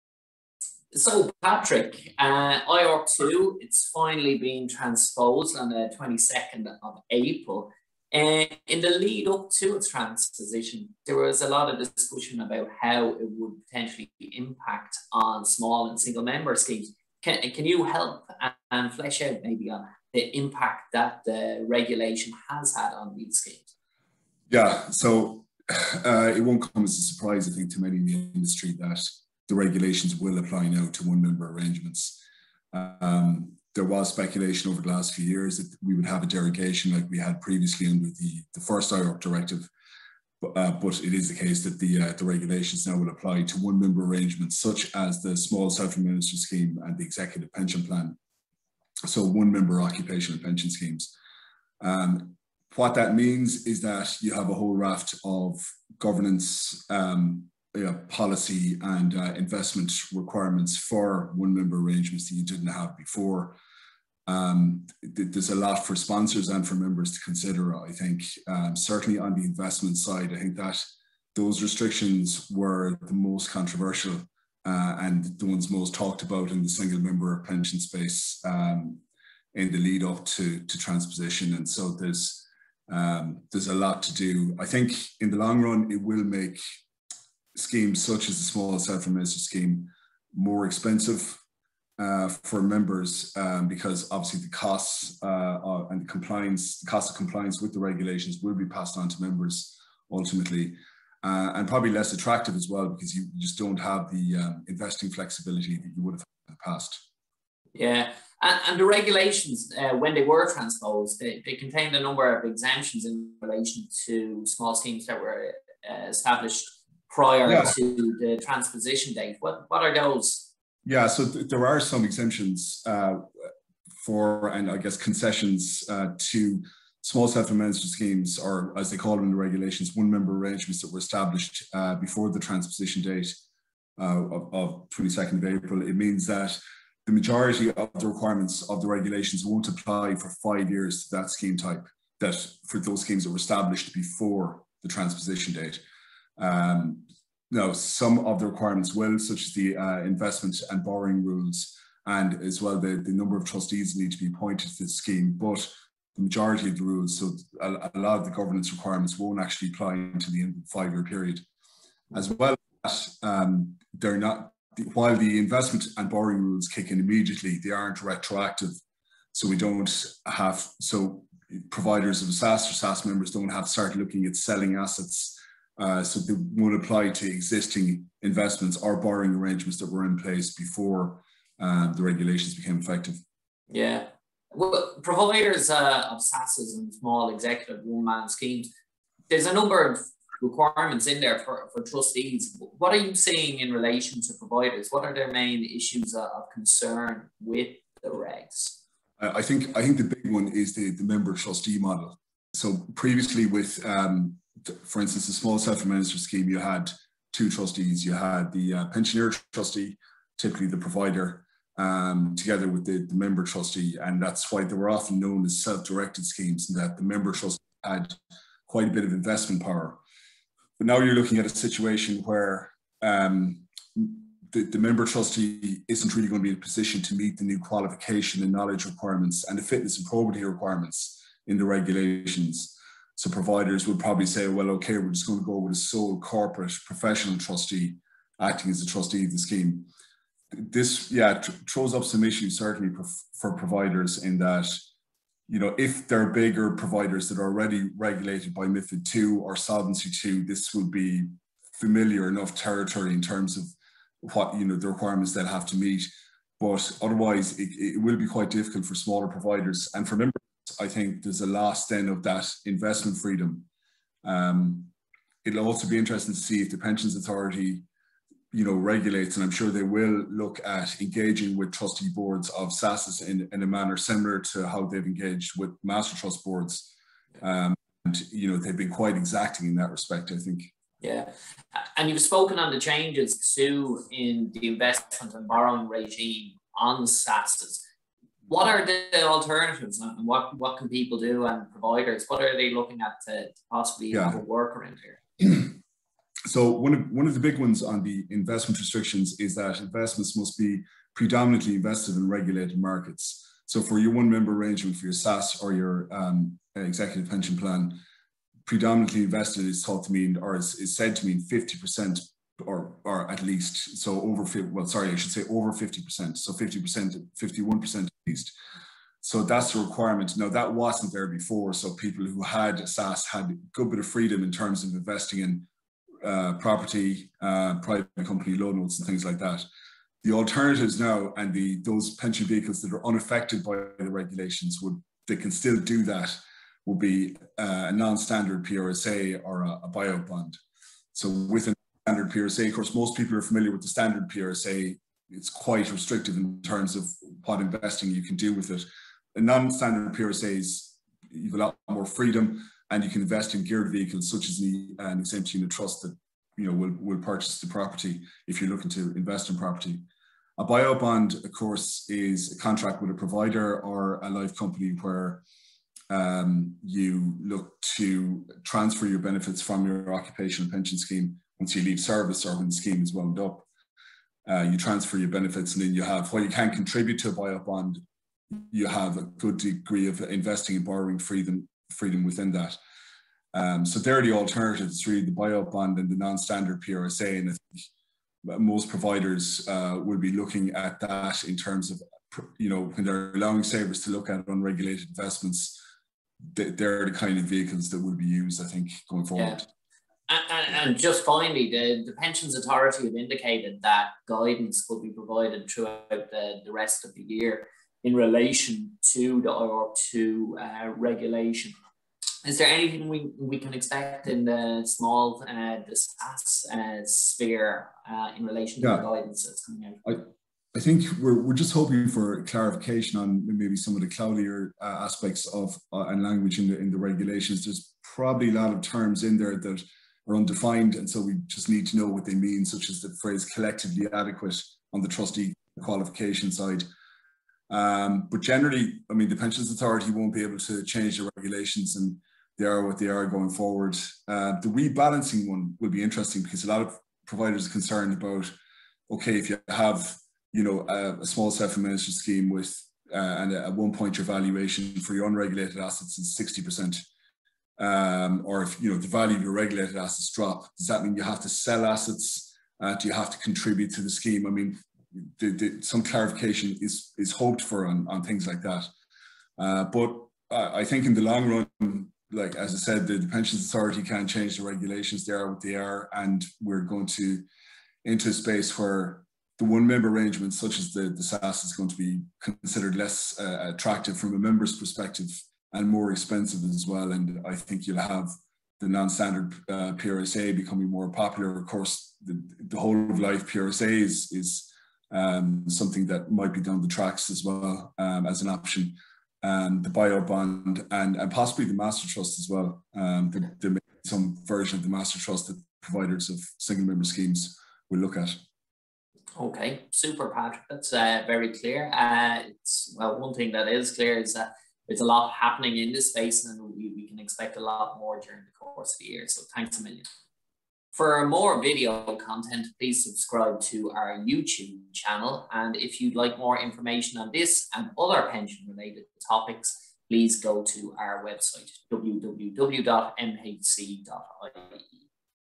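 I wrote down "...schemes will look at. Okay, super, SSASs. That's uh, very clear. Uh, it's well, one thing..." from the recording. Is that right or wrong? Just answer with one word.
wrong.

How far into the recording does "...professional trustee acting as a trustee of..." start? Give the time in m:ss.
3:56.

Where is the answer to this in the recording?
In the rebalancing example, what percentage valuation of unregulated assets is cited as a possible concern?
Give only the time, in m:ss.
7:36.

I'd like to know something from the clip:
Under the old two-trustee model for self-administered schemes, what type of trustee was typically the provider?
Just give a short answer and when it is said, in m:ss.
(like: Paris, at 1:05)
pensioner trustee, at 3:28.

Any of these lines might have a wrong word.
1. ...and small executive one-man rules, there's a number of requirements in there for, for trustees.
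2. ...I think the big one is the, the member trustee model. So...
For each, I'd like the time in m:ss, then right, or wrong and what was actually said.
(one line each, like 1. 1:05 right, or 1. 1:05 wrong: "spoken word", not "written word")
1. 3:06 wrong: "schemes", not "rules"
2. 3:19 right.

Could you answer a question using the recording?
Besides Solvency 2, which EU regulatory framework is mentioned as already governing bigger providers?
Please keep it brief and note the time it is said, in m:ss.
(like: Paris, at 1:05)
MiFID 2, at 4:08.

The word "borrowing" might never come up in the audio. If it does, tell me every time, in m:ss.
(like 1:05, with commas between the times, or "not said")
2:30, 2:46, 2:58, 4:45, 6:20.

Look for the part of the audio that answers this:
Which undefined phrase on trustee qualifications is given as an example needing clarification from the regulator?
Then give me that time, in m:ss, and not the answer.
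7:13.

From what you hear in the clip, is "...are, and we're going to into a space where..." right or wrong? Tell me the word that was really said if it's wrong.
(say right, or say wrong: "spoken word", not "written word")
right.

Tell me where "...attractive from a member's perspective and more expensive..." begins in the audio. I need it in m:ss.
8:03.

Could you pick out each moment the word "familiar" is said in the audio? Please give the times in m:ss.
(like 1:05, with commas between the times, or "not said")
4:11, 5:43.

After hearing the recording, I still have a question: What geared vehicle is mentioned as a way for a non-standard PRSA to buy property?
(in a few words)
exempt unit trust.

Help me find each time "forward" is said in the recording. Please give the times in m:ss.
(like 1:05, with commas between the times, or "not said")
6:39, 7:23.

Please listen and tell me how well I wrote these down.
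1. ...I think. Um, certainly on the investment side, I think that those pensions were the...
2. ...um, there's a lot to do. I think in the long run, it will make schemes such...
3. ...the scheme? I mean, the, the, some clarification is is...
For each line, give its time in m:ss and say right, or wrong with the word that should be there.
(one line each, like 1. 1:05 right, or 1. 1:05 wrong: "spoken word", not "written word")
1. 1:07 wrong: "restrictions", not "pensions"
2. 1:22 right
3. 7:44 right.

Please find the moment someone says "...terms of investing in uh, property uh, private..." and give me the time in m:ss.
5:24.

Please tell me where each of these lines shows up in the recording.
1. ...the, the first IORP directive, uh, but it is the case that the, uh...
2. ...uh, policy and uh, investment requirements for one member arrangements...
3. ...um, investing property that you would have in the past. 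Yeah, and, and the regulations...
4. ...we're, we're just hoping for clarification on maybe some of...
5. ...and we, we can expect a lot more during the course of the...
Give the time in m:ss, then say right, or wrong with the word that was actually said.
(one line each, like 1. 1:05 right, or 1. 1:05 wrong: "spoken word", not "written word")
1. 0:38 right
2. 0:57 right
3. 1:44 wrong: "flexibility", not "property"
4. 7:01 right
5. 8:36 right.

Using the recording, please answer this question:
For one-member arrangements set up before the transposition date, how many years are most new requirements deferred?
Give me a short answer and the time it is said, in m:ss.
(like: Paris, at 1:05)
5, at 2:20.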